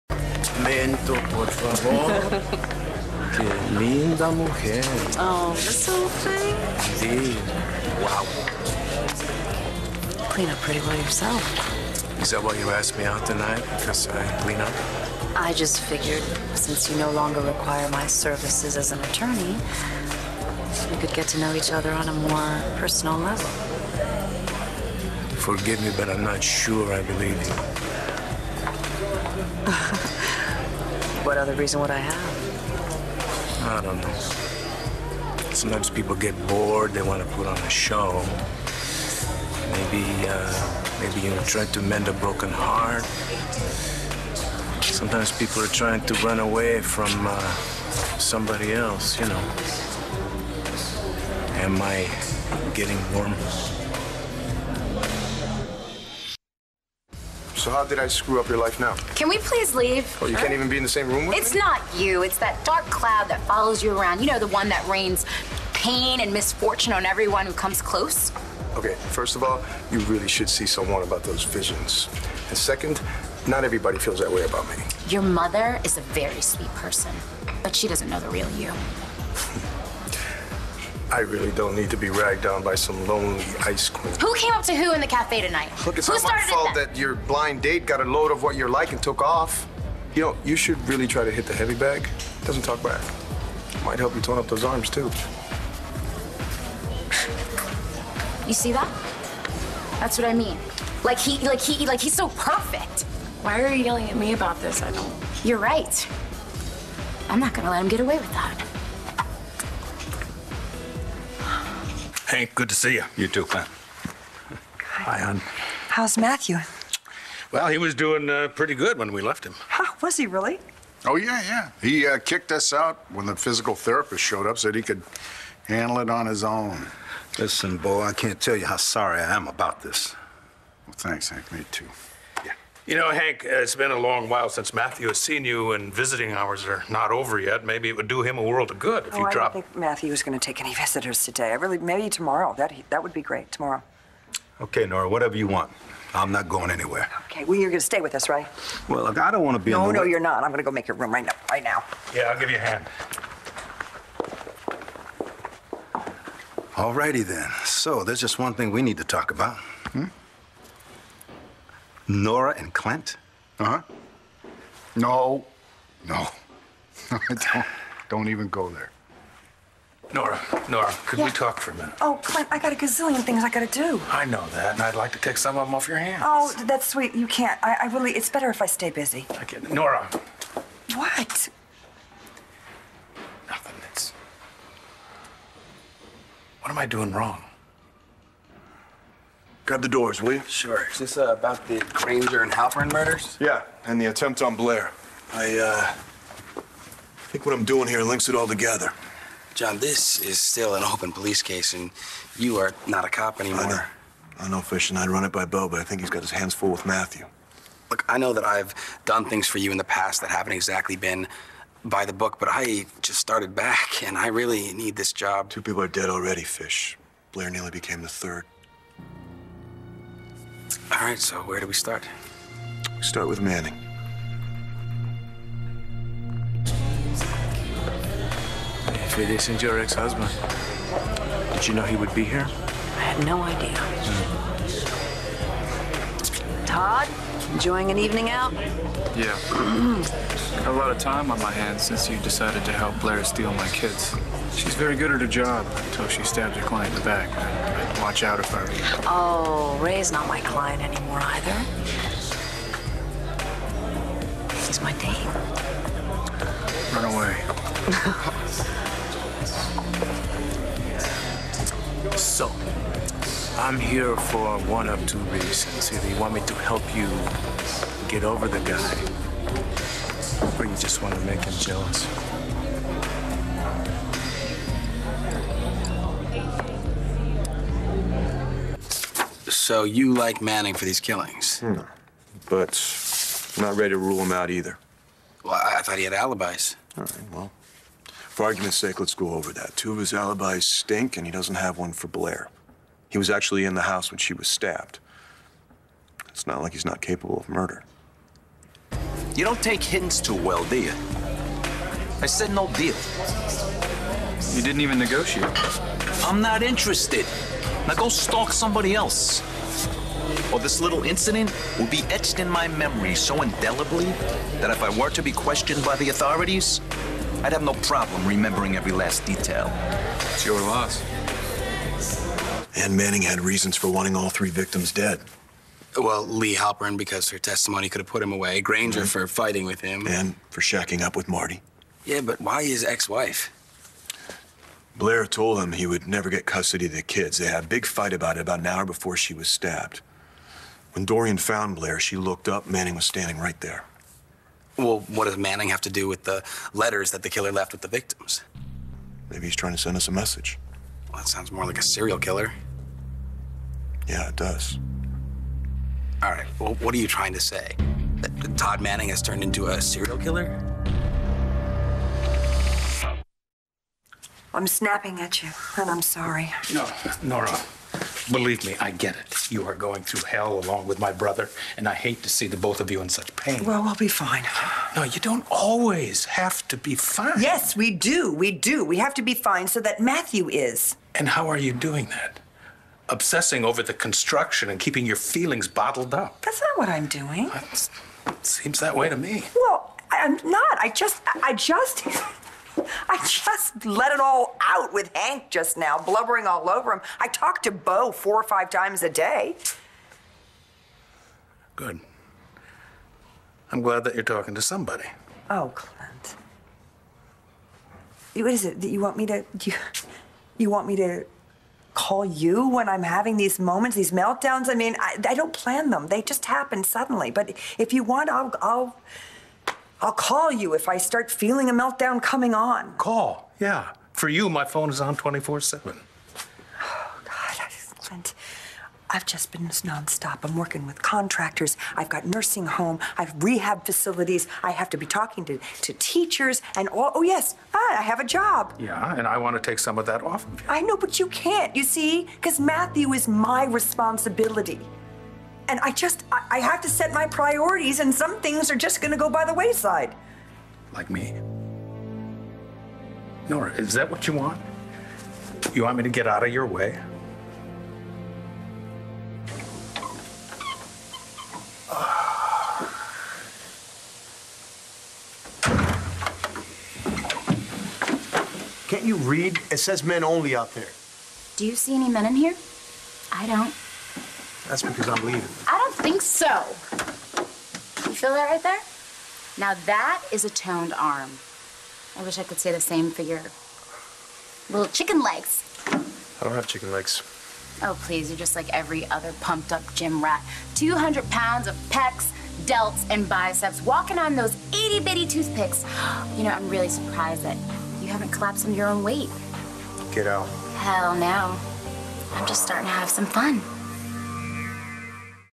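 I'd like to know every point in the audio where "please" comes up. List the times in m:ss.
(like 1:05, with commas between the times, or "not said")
0:59, 8:08.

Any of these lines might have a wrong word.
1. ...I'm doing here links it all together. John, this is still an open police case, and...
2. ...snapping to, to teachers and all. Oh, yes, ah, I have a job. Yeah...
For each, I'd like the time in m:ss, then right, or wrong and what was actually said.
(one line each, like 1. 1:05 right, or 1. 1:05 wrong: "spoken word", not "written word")
1. 3:17 right
2. 7:15 wrong: "talking", not "snapping".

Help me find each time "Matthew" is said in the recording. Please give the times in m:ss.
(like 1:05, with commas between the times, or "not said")
1:56, 2:14, 2:19, 3:26, 6:19, 7:22.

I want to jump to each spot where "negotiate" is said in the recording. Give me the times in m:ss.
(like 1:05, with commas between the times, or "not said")
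5:04.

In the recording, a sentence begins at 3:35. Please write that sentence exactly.
Two people are dead already, Fish.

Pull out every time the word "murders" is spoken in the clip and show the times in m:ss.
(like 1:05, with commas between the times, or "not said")
3:12, 4:57.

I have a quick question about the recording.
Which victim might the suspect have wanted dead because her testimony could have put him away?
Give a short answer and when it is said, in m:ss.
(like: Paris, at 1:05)
Lee Halperin, at 5:26.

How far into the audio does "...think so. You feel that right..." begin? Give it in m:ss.
7:55.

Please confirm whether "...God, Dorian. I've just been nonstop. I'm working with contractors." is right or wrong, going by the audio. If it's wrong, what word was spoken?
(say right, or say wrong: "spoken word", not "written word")
wrong: "Clint", not "Dorian".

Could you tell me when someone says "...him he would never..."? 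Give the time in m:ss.
5:35.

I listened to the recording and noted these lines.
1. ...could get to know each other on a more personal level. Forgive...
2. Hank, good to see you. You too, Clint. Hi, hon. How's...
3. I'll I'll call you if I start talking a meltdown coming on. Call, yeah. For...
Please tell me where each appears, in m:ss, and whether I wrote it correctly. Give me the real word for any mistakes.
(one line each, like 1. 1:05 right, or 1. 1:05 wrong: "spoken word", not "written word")
1. 0:20 right
2. 1:52 right
3. 6:58 wrong: "feeling", not "talking".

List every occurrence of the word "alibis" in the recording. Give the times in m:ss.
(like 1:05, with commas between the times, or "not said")
4:46, 4:50.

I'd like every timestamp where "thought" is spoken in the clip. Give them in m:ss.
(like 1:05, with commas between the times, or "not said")
4:45.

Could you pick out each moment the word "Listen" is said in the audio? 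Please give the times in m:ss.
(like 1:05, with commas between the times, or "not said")
2:07.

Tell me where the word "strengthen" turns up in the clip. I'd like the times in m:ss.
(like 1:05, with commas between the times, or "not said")
not said.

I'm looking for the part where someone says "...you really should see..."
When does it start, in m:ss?
1:09.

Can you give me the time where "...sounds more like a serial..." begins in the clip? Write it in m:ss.
5:51.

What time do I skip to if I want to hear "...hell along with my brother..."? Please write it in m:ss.
6:10.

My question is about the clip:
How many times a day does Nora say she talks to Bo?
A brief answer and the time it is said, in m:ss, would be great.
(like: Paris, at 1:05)
4 or 5, at 6:38.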